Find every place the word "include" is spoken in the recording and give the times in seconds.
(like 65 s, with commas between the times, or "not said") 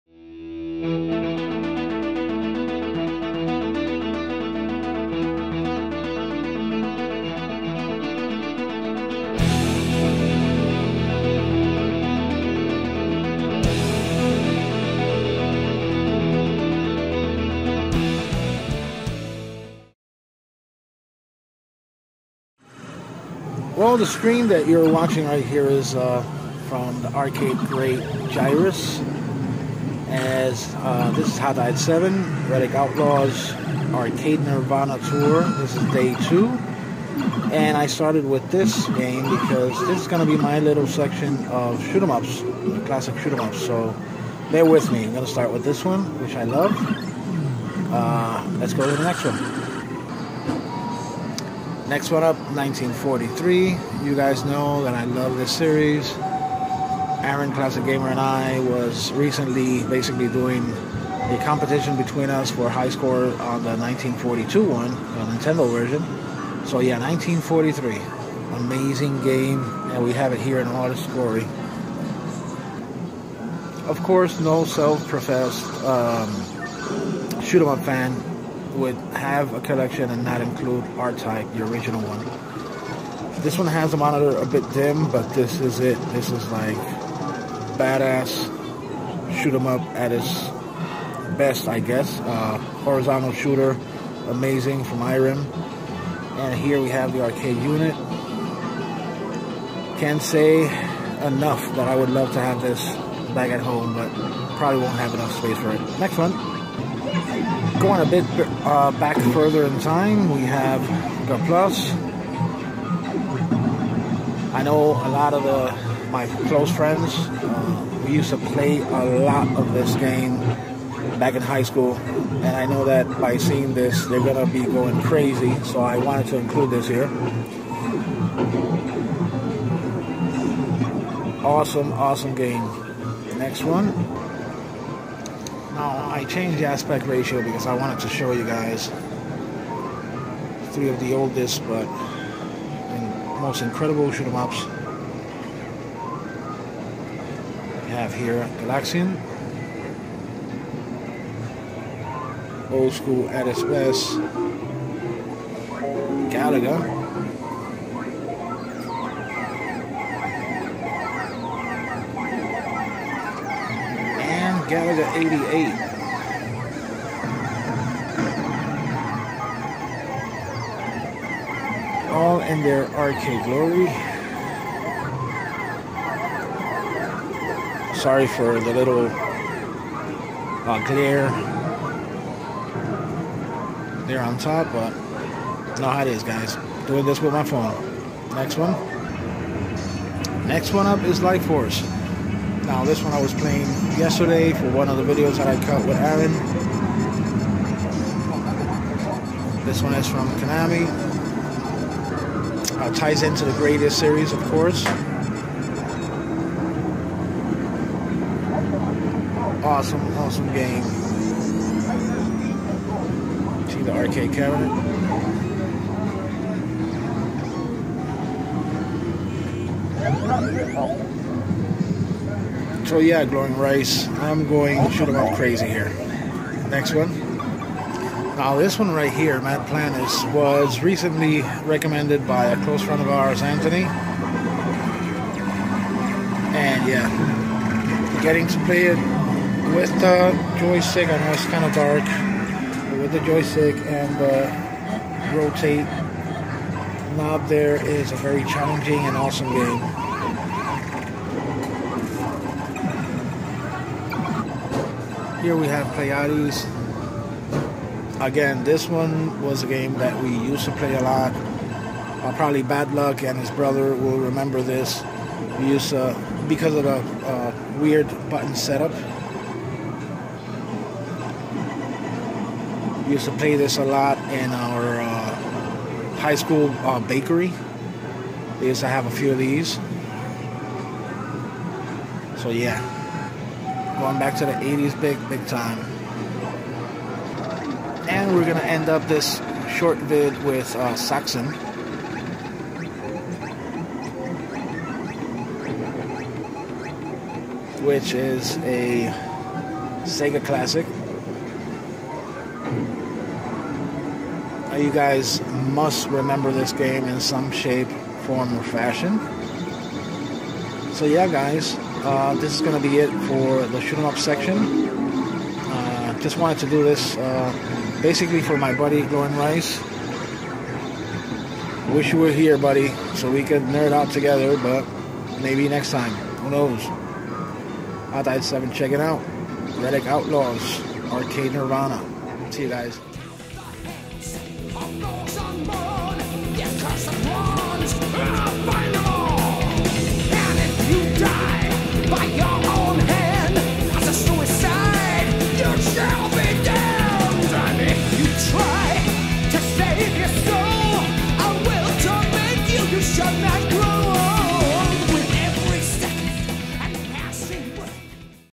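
80 s, 126 s.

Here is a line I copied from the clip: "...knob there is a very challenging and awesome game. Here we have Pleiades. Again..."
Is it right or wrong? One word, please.
right.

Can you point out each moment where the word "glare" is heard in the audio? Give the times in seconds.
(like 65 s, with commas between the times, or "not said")
180 s.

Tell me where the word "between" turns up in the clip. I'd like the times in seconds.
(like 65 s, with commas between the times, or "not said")
61 s.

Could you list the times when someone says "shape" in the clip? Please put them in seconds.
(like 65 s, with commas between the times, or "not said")
307 s.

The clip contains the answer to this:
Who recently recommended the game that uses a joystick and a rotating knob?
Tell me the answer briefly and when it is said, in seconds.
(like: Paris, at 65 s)
Anthony, at 233 s.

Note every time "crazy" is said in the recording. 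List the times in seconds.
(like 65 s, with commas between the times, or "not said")
125 s, 225 s.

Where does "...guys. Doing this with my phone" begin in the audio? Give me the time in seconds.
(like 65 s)
186 s.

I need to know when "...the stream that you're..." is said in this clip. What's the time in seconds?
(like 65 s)
23 s.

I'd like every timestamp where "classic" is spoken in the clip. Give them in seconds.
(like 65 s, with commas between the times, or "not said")
42 s, 57 s, 300 s.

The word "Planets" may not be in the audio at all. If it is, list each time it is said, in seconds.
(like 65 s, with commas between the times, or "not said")
229 s.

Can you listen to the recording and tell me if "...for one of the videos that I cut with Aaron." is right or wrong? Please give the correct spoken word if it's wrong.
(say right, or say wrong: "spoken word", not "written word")
right.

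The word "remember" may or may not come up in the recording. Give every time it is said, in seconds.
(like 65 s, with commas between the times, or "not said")
264 s, 306 s.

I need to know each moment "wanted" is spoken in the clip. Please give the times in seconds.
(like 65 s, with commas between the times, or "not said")
125 s, 137 s, 316 s.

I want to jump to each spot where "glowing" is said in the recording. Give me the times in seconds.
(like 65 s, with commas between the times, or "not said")
223 s, 319 s.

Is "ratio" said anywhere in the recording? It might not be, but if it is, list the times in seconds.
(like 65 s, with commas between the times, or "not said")
137 s.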